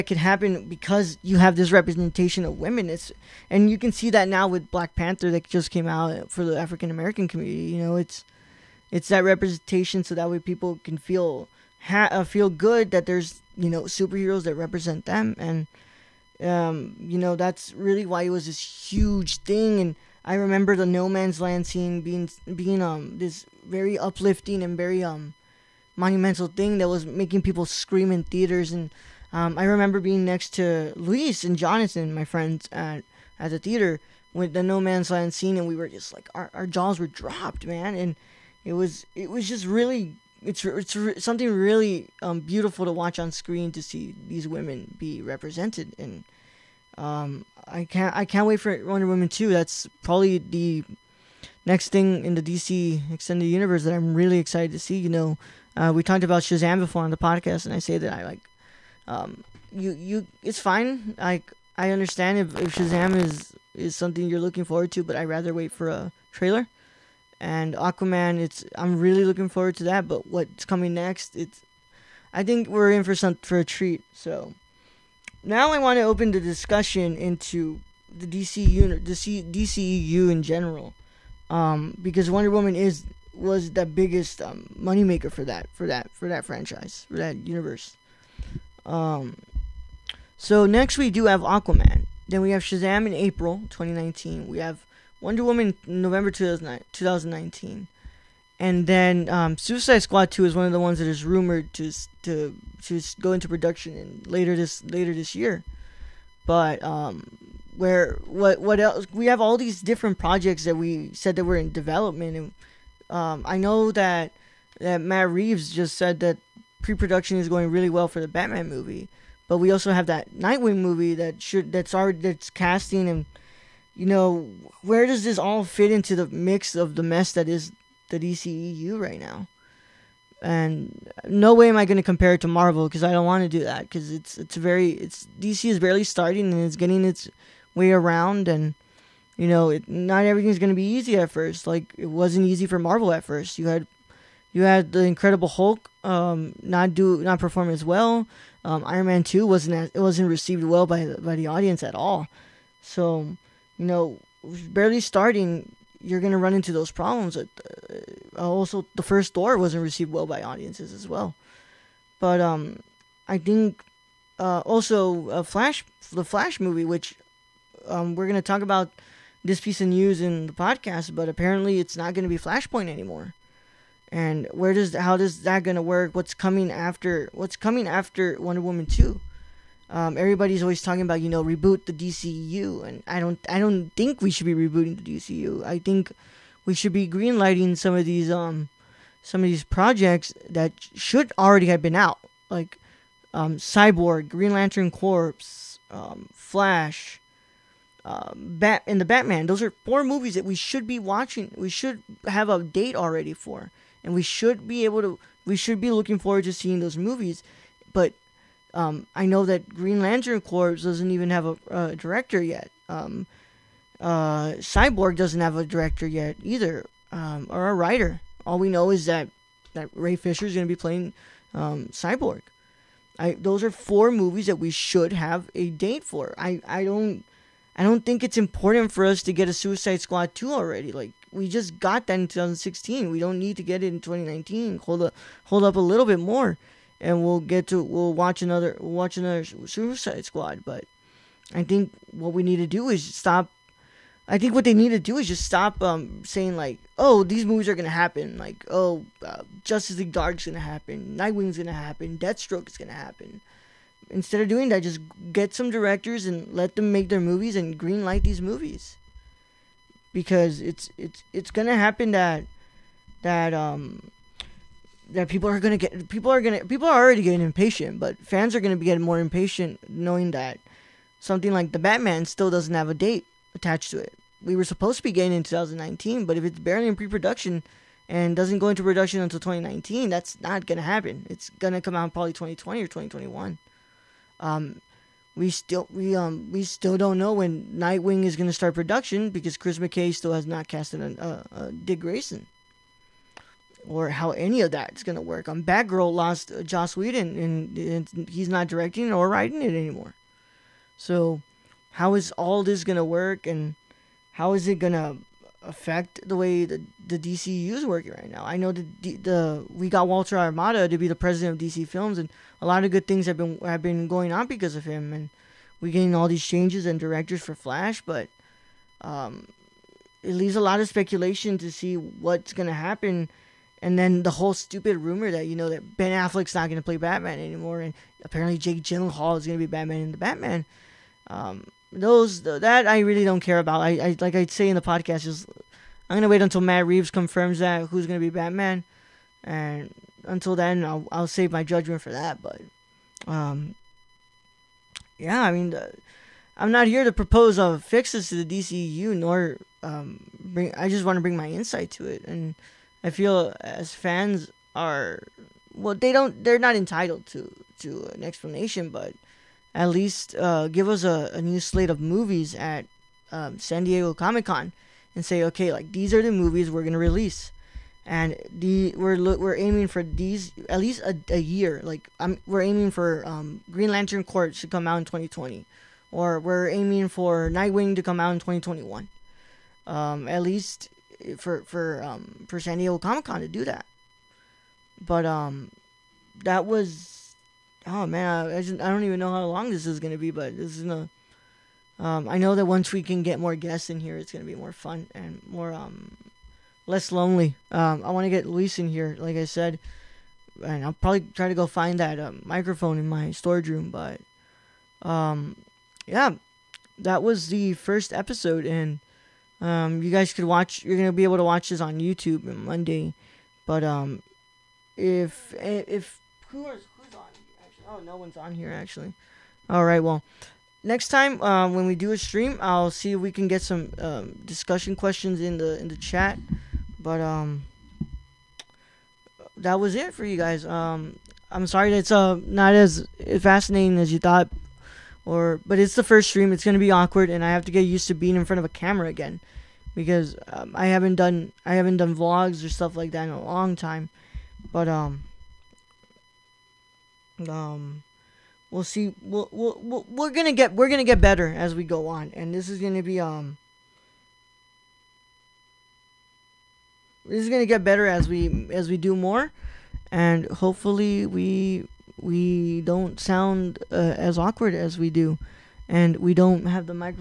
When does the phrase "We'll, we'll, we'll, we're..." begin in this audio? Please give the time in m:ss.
7:29.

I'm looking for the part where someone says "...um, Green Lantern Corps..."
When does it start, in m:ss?
6:13.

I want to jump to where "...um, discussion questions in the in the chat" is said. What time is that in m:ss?
7:03.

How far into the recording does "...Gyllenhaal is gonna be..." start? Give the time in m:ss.
5:28.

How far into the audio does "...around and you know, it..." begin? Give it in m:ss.
2:17.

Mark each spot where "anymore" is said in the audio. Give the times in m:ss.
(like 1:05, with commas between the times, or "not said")
2:52, 4:59, 5:27.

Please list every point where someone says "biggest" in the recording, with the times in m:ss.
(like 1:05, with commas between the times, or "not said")
1:23.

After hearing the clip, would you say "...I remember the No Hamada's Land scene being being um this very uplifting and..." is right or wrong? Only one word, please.
wrong.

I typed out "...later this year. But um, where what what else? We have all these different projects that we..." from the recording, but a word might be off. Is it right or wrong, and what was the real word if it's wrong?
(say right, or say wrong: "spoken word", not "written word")
right.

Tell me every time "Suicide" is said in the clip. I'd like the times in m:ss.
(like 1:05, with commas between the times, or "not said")
1:39, 3:49, 3:59.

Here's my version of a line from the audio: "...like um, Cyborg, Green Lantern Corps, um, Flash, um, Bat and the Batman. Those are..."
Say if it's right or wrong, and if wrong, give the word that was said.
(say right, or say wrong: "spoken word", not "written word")
right.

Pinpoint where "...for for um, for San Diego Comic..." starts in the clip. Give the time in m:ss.
6:21.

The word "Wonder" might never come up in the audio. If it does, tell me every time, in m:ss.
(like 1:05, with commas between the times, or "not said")
0:48, 1:22, 1:35, 2:58.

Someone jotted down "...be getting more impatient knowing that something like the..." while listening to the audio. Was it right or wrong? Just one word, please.
right.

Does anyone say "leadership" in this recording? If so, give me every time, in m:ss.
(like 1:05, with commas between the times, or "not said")
not said.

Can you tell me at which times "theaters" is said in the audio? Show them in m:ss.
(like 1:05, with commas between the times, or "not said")
0:28, 0:33.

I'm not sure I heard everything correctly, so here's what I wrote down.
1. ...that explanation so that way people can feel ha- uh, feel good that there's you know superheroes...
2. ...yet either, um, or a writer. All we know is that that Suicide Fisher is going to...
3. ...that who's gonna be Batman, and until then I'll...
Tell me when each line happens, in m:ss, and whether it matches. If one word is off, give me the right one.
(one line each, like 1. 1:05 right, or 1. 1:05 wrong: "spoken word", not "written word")
1. 0:09 wrong: "representation", not "explanation"
2. 3:36 wrong: "Ray", not "Suicide"
3. 5:37 right.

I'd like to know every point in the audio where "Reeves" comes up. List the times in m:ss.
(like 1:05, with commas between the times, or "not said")
1:55, 5:36.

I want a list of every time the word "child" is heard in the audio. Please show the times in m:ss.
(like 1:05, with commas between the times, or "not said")
not said.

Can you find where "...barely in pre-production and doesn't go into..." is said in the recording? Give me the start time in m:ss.
4:36.